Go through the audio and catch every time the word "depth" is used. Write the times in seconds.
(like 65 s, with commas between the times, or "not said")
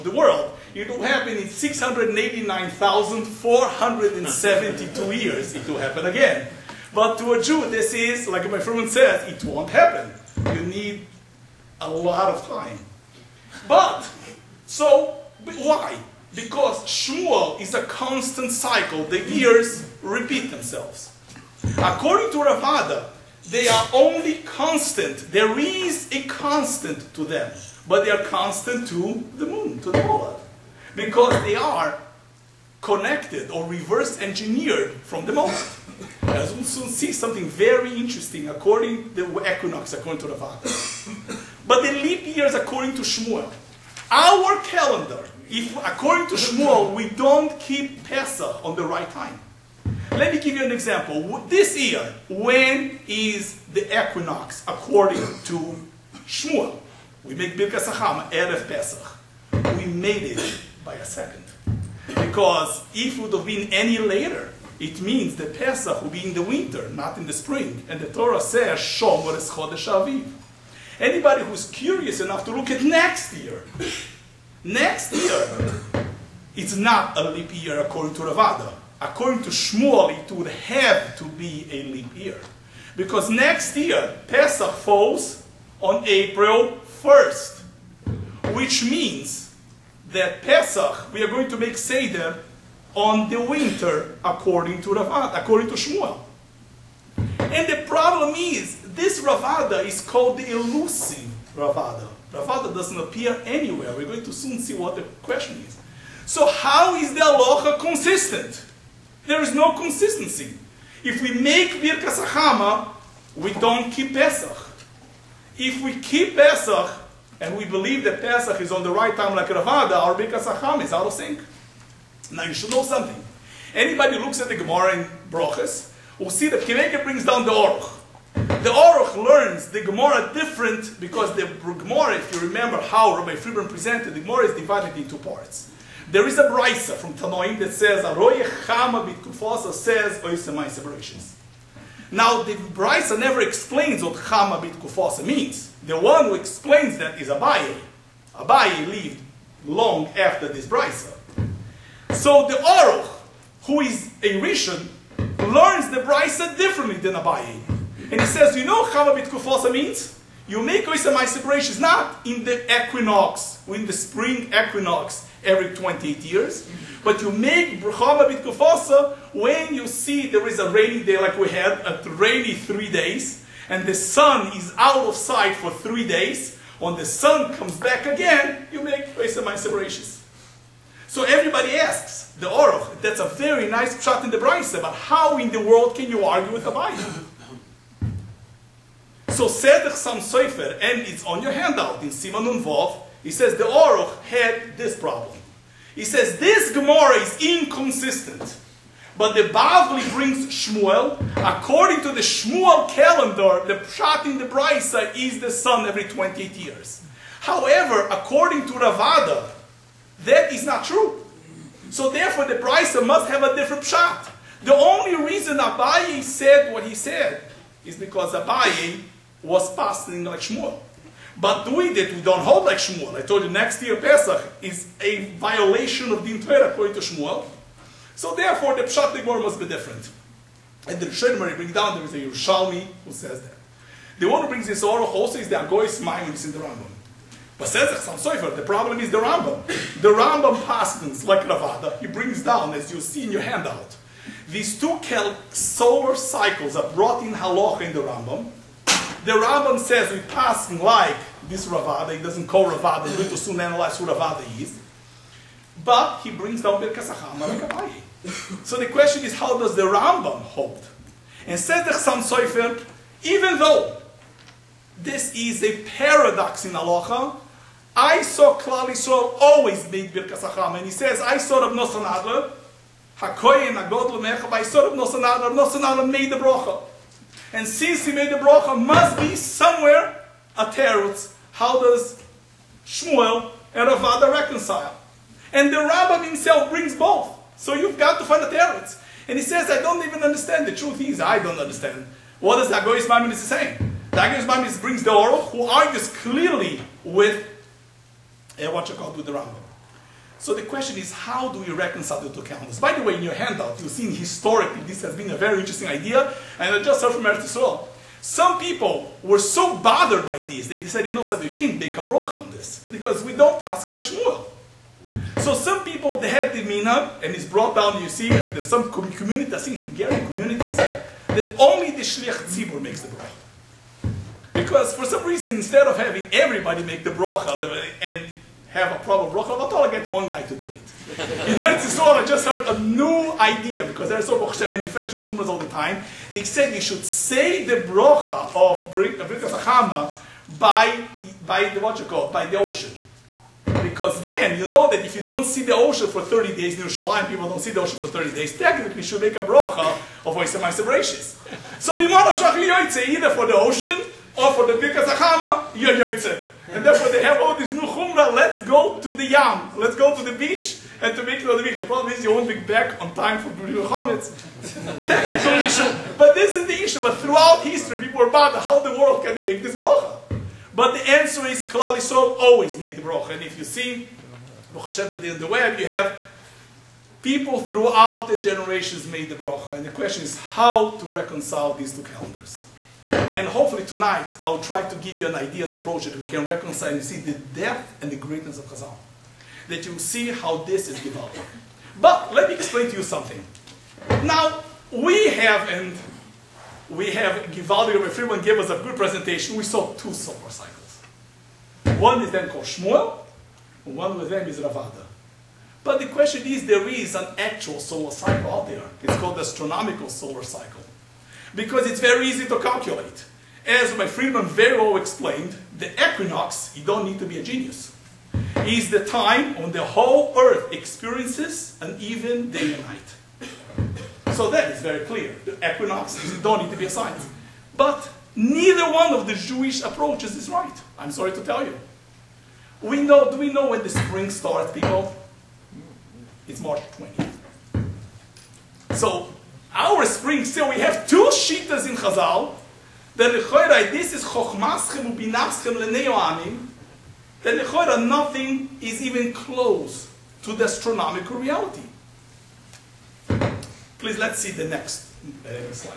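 387 s.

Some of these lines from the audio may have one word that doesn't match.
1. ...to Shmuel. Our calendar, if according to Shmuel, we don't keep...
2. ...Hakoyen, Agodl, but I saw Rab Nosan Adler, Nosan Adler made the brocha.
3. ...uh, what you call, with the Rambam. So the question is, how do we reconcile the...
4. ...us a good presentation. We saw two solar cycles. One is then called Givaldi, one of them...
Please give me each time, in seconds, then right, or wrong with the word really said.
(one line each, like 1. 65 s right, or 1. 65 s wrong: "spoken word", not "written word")
1. 42 s right
2. 273 s right
3. 298 s right
4. 398 s wrong: "Shmuel", not "Givaldi".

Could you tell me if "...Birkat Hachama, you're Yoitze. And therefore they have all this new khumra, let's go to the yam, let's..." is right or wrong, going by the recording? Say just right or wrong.
right.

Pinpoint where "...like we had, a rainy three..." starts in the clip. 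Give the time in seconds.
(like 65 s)
171 s.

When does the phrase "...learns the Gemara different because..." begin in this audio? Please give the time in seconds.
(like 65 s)
129 s.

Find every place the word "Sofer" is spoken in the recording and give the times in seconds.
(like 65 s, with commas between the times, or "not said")
190 s, 238 s.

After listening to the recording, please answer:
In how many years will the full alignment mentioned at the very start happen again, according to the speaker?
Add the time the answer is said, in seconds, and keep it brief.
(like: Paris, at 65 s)
689,472, at 1 s.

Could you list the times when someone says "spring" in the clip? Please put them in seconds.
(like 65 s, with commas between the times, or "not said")
67 s, 163 s, 433 s, 440 s.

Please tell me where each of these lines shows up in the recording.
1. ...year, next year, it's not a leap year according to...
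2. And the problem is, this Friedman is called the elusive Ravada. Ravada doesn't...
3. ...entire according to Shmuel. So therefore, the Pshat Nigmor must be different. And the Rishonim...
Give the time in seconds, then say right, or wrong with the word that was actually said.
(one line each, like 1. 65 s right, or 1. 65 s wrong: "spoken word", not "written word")
1. 73 s right
2. 97 s wrong: "Ravada", not "Friedman"
3. 226 s right.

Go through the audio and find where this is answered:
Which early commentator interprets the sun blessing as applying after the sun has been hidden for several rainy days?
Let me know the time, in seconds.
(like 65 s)
152 s.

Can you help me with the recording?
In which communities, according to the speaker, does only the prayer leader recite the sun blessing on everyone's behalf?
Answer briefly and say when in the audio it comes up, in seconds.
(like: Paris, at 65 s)
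Hungarian communities, at 319 s.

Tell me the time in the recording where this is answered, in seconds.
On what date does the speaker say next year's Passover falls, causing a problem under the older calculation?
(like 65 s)
86 s.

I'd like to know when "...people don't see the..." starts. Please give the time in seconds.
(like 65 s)
347 s.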